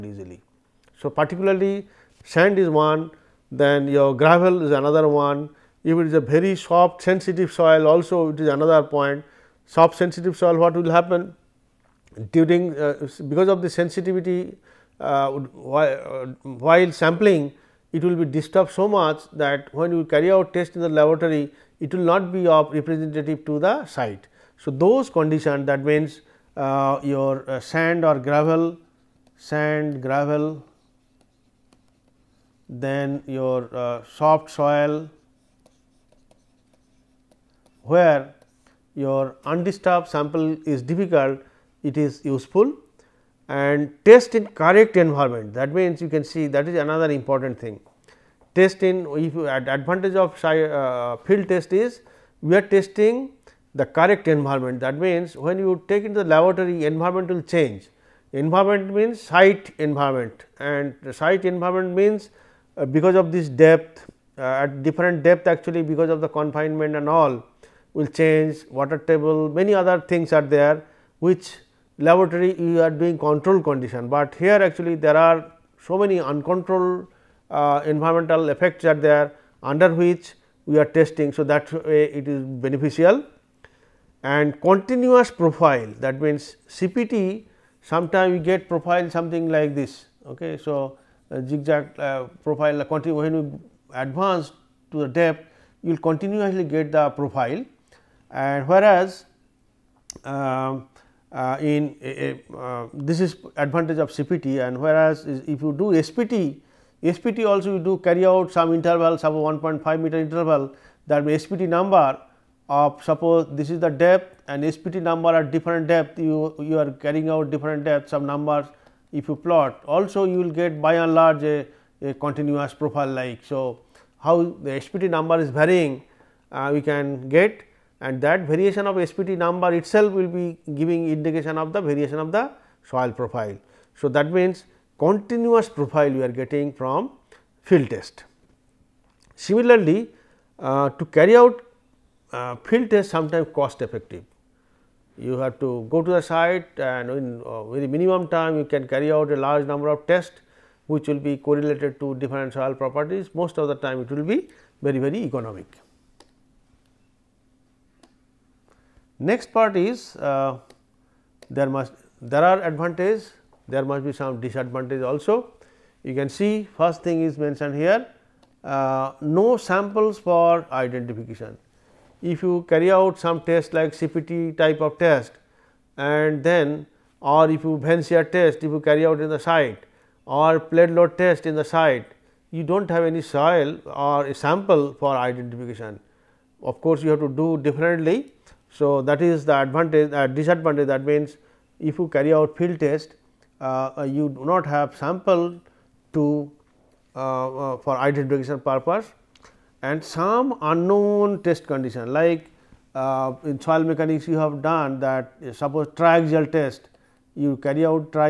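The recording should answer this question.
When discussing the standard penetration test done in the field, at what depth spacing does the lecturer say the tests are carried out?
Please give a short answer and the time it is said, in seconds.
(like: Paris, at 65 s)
1.5 meter, at 109 s.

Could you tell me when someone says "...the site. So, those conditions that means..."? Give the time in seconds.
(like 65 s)
23 s.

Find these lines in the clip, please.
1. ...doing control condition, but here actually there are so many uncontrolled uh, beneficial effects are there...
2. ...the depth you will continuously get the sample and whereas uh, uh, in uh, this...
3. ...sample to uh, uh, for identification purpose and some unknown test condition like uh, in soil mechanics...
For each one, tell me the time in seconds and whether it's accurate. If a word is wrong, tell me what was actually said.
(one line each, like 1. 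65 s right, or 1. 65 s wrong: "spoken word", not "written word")
1. 72 s wrong: "environmental", not "beneficial"
2. 95 s wrong: "profile", not "sample"
3. 194 s right.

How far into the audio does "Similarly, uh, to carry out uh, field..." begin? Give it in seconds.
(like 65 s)
139 s.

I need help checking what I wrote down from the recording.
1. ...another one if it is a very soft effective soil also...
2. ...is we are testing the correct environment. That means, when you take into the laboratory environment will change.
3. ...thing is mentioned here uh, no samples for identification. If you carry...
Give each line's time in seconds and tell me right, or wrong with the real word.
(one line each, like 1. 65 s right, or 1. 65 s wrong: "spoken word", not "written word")
1. 4 s wrong: "sensitive", not "effective"
2. 51 s right
3. 167 s right.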